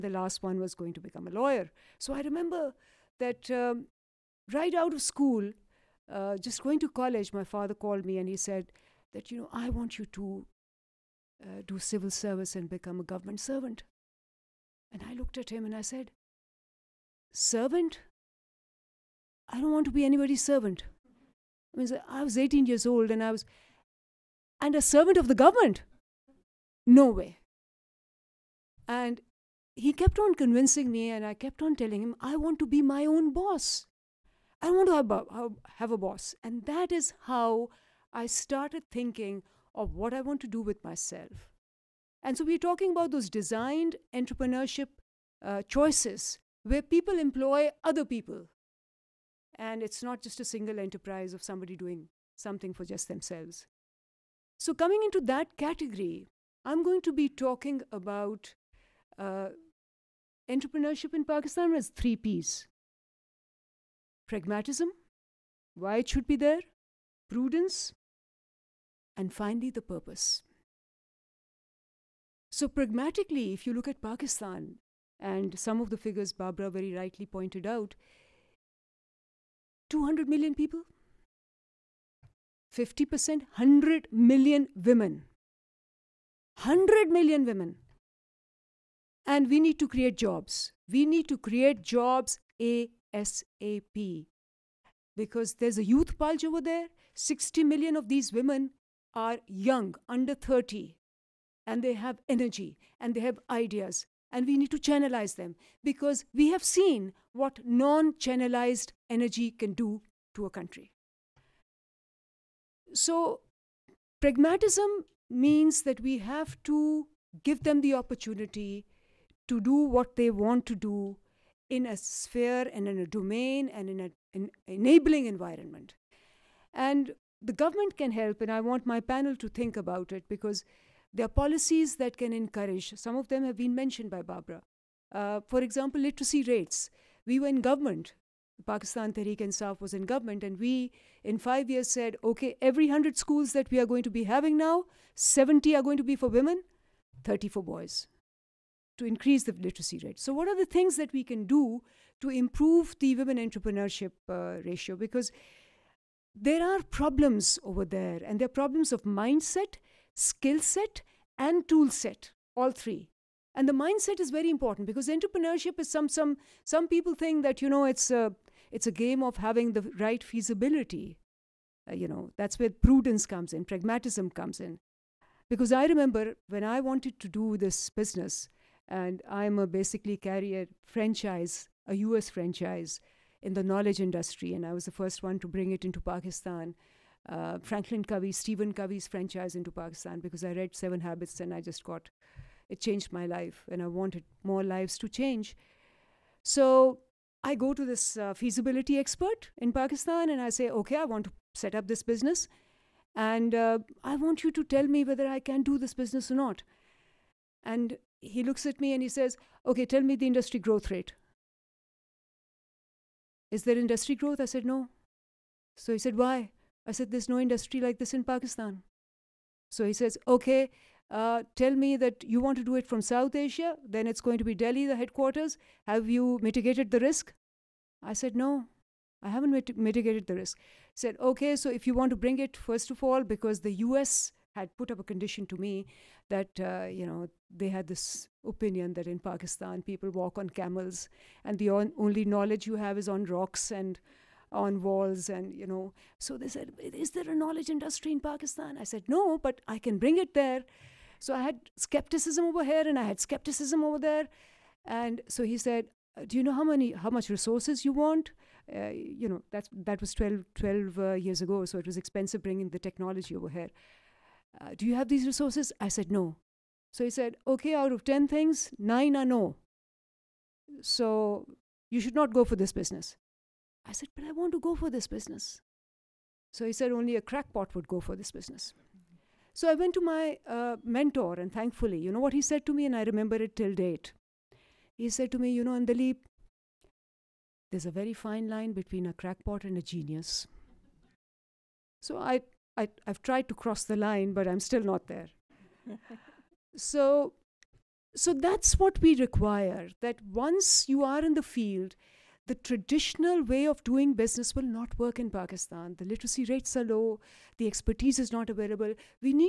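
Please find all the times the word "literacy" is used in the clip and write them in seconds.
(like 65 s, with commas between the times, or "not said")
135 s, 149 s, 306 s.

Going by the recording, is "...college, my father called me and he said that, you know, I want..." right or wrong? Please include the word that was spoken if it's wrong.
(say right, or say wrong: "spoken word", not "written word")
right.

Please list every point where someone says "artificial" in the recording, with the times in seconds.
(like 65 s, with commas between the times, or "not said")
not said.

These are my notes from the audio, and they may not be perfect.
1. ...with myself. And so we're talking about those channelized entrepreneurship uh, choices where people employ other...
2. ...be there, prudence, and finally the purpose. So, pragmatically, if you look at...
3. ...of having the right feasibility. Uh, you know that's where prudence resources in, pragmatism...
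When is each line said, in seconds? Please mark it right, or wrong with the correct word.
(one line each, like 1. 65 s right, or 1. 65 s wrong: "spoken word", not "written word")
1. 40 s wrong: "designed", not "channelized"
2. 66 s right
3. 169 s wrong: "comes", not "resources".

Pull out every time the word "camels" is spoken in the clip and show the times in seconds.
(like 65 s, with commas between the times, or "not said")
240 s.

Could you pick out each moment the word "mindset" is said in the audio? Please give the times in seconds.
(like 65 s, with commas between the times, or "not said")
159 s, 163 s.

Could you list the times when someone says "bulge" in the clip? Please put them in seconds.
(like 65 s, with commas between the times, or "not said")
96 s.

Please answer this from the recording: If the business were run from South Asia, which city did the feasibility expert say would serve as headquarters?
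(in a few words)
Delhi.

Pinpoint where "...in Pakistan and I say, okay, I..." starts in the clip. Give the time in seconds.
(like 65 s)
199 s.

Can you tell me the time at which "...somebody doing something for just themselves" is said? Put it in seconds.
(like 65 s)
51 s.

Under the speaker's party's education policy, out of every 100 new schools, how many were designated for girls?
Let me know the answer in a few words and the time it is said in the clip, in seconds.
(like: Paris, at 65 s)
70, at 145 s.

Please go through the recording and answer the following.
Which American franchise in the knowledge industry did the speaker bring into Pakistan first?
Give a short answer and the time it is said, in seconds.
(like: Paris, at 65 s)
Franklin Covey, at 187 s.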